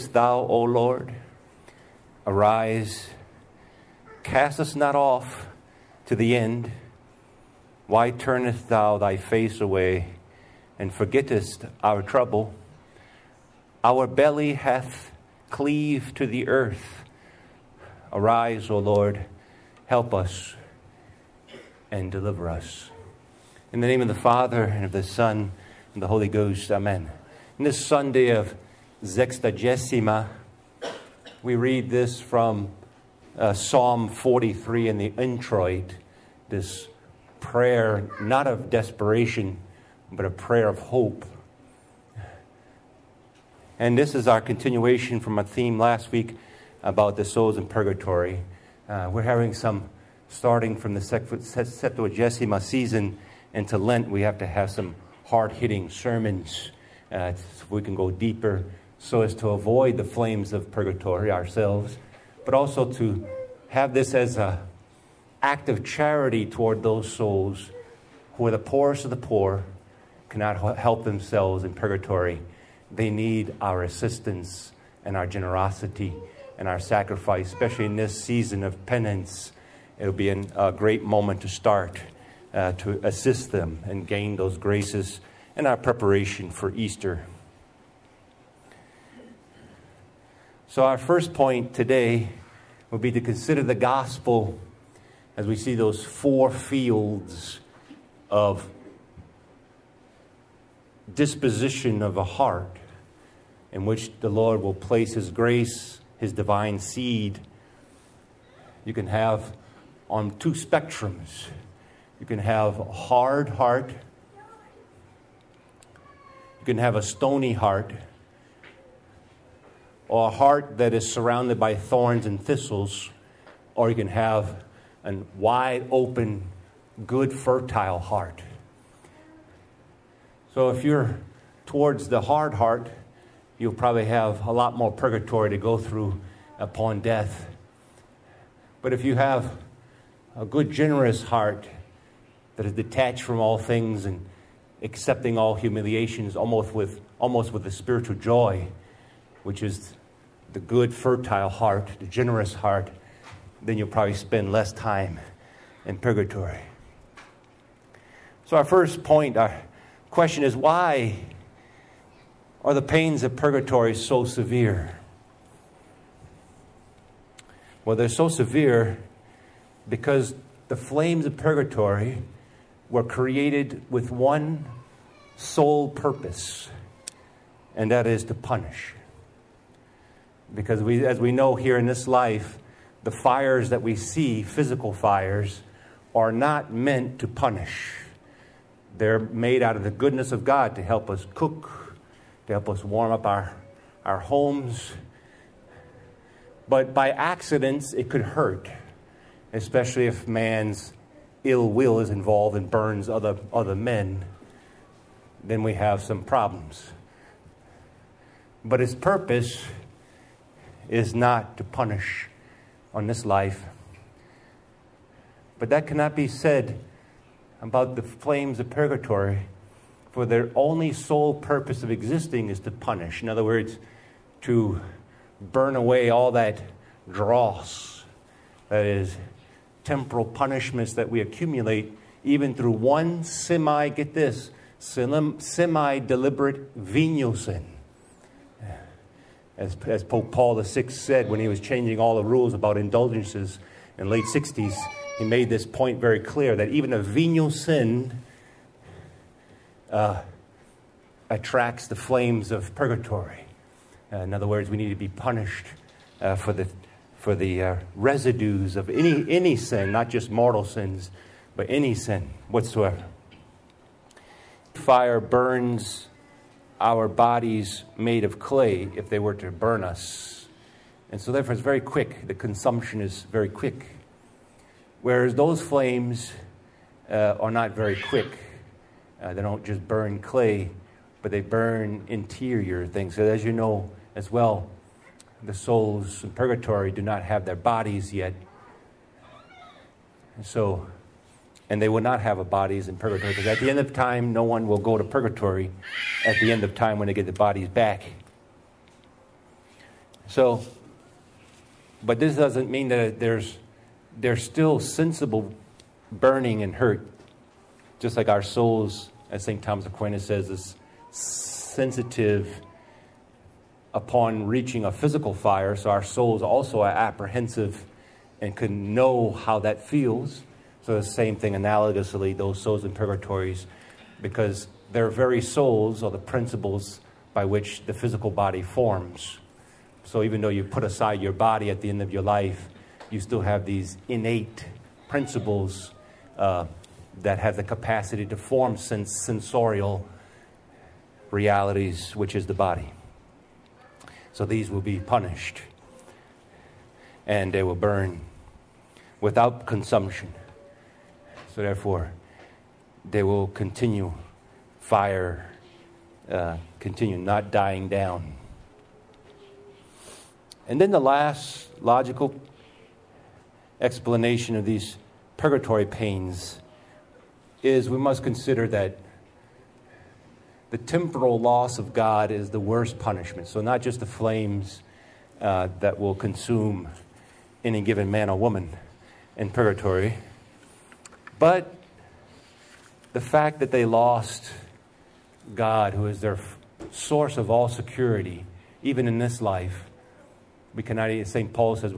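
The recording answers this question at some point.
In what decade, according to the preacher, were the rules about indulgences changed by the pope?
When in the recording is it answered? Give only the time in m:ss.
4:04.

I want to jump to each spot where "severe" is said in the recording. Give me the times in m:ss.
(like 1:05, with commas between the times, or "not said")
2:44, 2:48.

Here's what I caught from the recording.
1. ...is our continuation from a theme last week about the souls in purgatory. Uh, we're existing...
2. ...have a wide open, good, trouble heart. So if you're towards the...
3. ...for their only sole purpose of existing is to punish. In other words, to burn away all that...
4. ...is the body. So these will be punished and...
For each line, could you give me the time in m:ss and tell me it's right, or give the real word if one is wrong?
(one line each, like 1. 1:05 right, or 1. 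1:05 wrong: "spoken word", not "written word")
1. 0:44 wrong: "having", not "existing"
2. 2:04 wrong: "fertile", not "trouble"
3. 3:40 right
4. 5:42 right.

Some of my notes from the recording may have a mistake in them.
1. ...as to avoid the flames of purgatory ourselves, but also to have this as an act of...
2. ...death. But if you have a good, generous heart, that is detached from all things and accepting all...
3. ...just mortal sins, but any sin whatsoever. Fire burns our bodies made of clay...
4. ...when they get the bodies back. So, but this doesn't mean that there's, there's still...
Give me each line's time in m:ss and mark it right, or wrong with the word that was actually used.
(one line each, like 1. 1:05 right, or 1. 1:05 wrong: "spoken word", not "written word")
1. 0:59 right
2. 2:16 right
3. 4:20 right
4. 4:56 right.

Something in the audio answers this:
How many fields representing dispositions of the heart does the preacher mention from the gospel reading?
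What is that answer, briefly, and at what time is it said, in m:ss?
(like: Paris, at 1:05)
4, at 1:36.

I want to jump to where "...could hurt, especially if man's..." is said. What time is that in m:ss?
3:18.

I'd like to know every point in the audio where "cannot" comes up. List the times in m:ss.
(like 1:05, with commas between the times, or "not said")
1:10, 3:35, 6:30.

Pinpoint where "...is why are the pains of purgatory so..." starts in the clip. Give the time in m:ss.
2:40.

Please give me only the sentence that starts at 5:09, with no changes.
Thomas Aquinas says, is sensitive upon reaching a physical fire, so our souls also are apprehensive and can know how that feels.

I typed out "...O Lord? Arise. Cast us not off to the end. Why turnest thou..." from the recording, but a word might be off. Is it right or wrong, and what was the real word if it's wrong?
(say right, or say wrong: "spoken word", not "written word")
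right.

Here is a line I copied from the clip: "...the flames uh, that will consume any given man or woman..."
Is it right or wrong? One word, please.
right.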